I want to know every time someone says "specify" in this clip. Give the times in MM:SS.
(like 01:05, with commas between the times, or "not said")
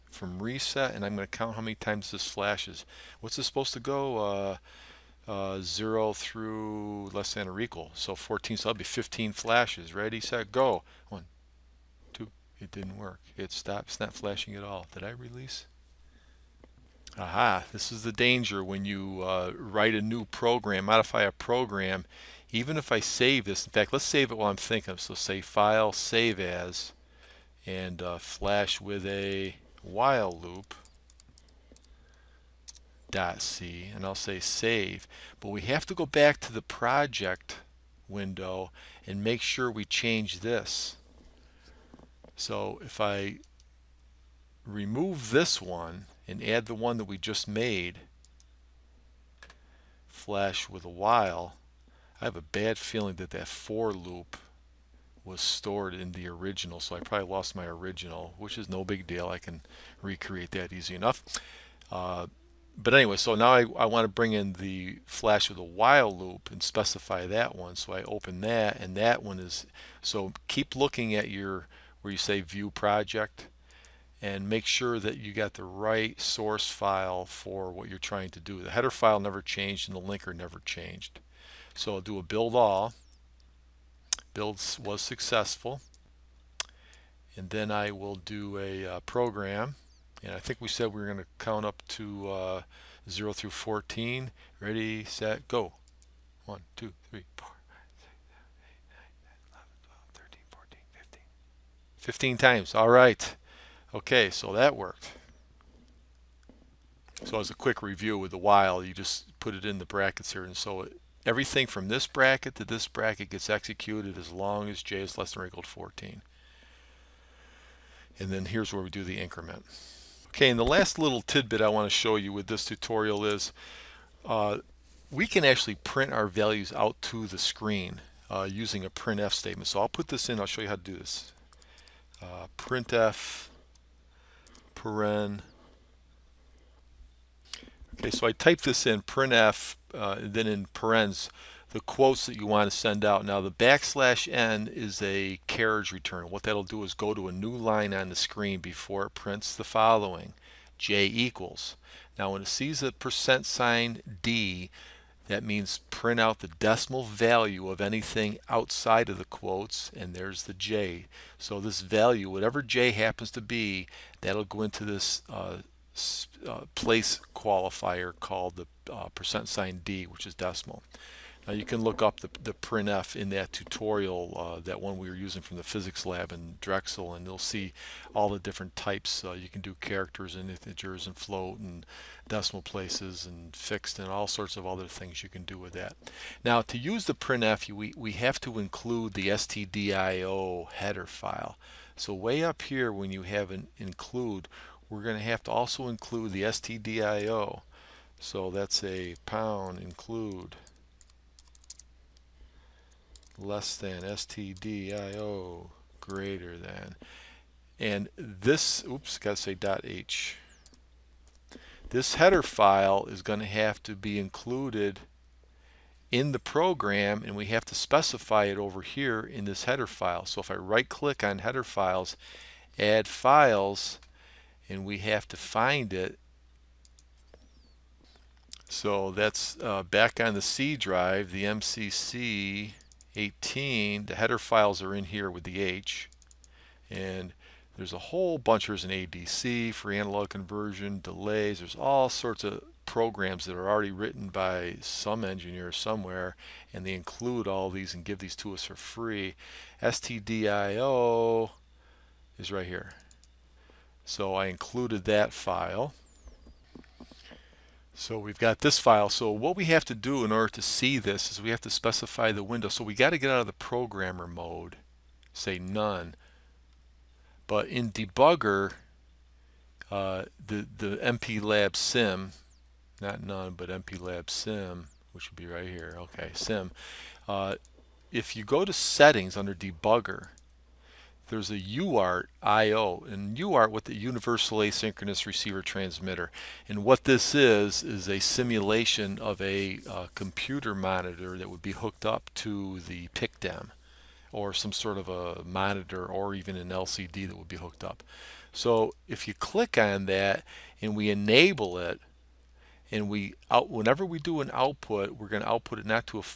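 01:06, 03:37, 04:21.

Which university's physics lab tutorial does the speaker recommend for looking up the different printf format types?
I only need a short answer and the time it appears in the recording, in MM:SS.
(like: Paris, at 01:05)
Drexel, at 02:56.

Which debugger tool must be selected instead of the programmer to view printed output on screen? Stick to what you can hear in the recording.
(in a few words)
MPLAB sim.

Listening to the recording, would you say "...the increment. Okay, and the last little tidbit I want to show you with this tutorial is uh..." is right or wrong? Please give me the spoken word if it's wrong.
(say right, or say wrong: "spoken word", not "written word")
right.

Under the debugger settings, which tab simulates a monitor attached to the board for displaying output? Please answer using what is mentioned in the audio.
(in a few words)
UART IO.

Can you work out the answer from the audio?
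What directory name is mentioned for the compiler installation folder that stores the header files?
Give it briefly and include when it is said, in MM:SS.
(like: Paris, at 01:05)
MCC 18, at 03:51.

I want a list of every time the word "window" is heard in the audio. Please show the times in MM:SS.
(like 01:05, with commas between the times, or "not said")
00:38, 04:22.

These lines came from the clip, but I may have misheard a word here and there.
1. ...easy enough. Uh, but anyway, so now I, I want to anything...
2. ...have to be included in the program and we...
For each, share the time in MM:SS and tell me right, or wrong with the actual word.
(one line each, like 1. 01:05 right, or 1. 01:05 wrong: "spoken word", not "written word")
1. 01:00 wrong: "bring", not "anything"
2. 03:33 right.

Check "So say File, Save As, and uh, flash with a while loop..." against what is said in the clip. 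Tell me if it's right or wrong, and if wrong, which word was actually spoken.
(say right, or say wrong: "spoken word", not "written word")
right.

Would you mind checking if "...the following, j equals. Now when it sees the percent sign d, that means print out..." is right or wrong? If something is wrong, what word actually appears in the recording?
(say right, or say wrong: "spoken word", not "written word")
right.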